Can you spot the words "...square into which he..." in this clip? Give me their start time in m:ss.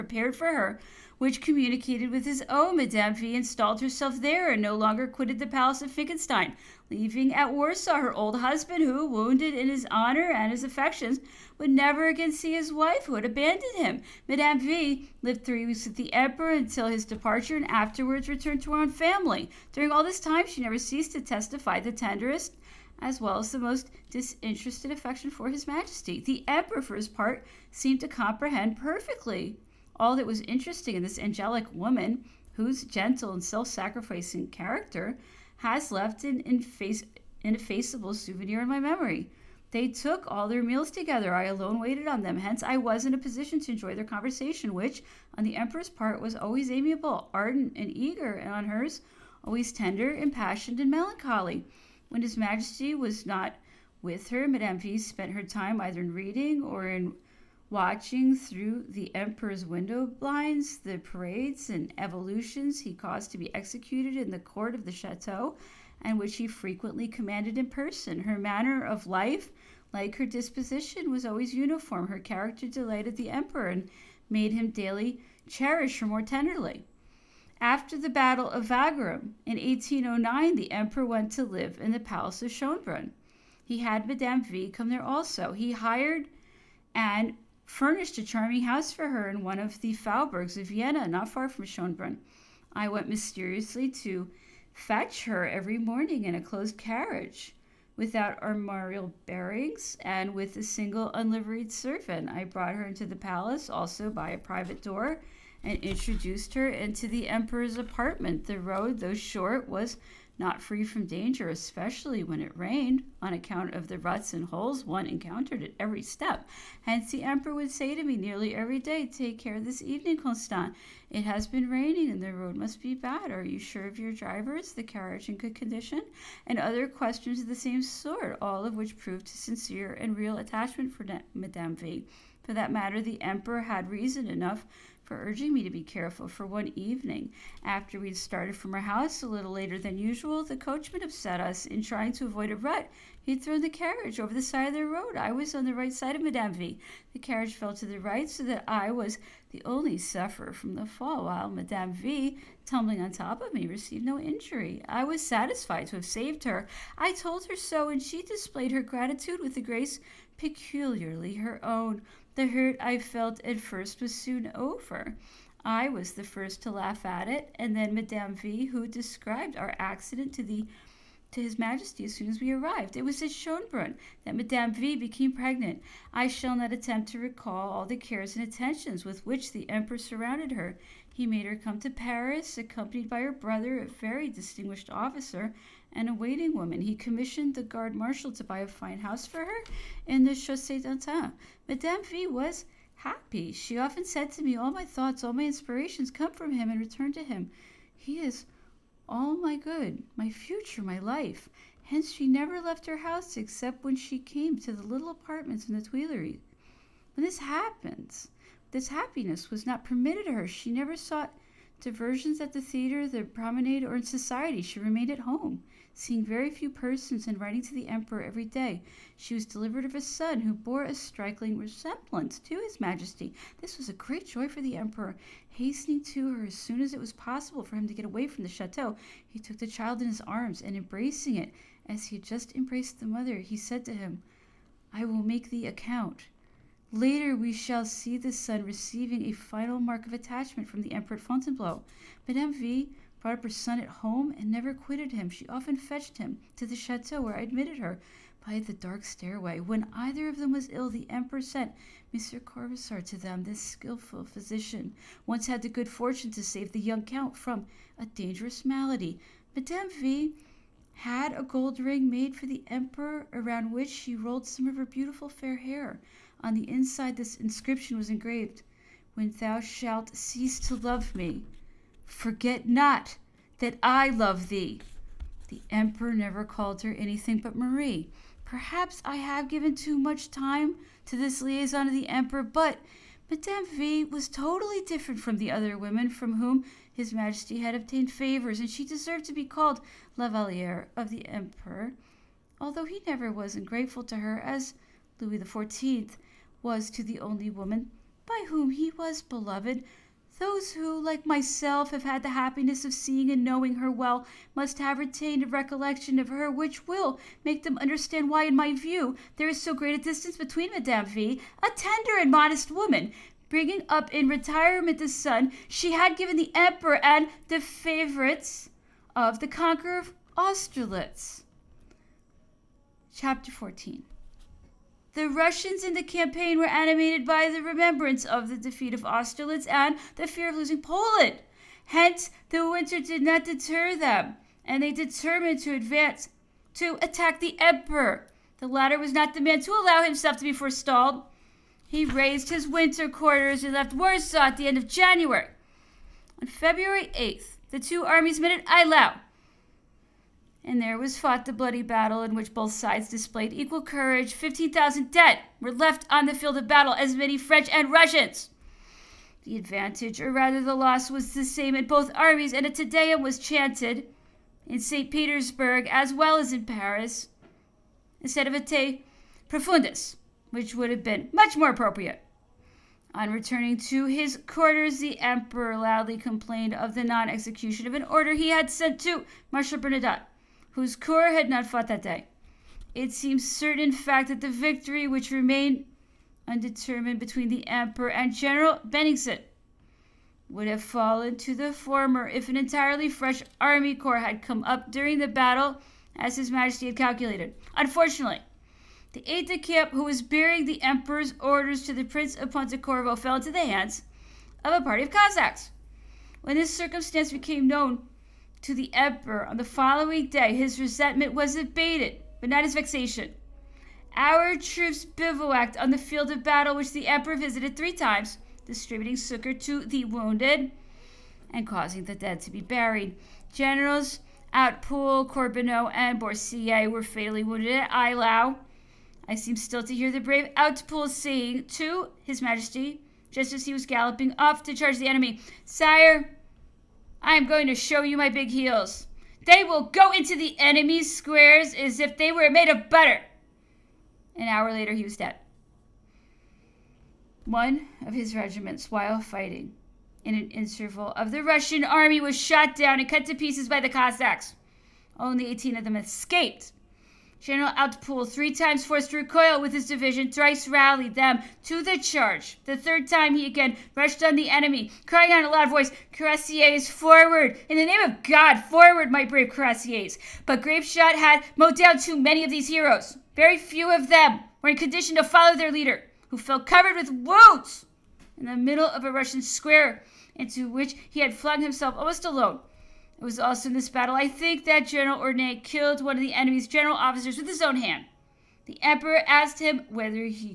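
7:59.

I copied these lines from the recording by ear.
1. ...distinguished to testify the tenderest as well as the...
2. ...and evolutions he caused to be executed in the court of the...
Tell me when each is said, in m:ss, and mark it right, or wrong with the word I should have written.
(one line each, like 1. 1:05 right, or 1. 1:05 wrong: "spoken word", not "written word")
1. 0:20 wrong: "ceased", not "distinguished"
2. 1:01 right.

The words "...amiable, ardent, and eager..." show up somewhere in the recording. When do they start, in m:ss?
0:46.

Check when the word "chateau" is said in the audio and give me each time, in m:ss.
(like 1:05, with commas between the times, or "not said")
1:04, 3:48, 4:06.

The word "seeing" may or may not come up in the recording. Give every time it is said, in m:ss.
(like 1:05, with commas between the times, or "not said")
3:35, 5:02.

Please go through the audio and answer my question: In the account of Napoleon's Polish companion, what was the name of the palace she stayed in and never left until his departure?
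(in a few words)
Finkenstein.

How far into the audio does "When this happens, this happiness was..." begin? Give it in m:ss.
3:27.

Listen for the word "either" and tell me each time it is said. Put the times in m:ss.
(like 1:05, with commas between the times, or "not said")
0:55, 4:09.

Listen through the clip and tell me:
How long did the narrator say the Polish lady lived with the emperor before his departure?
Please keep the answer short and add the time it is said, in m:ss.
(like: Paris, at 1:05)
3 weeks, at 0:15.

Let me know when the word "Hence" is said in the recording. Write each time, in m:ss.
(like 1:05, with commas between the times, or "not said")
0:42, 1:56, 3:21, 5:31.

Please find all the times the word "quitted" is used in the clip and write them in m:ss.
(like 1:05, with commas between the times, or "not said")
0:05, 4:04.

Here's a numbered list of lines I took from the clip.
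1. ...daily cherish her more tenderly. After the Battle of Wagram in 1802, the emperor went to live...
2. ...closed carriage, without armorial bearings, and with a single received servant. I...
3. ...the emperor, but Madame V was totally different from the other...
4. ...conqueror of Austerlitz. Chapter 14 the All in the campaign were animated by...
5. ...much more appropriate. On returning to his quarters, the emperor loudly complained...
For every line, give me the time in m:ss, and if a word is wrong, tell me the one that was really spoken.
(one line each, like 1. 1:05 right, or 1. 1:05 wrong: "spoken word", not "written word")
1. 1:14 wrong: "1809", not "1802"
2. 1:36 wrong: "unliveried", not "received"
3. 4:41 right
4. 5:19 wrong: "Russians", not "All"
5. 6:11 right.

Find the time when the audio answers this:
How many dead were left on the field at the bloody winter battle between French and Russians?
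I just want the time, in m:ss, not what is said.
5:54.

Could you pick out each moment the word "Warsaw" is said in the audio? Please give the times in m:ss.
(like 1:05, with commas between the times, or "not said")
0:07, 5:43.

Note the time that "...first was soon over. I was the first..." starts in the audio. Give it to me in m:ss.
2:43.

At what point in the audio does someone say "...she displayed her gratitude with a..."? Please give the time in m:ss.
2:38.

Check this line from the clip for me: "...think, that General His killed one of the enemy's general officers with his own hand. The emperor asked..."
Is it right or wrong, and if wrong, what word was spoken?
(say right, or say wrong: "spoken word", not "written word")
wrong: "Ornette", not "His".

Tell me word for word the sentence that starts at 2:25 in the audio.
I was on the right side of Madame V.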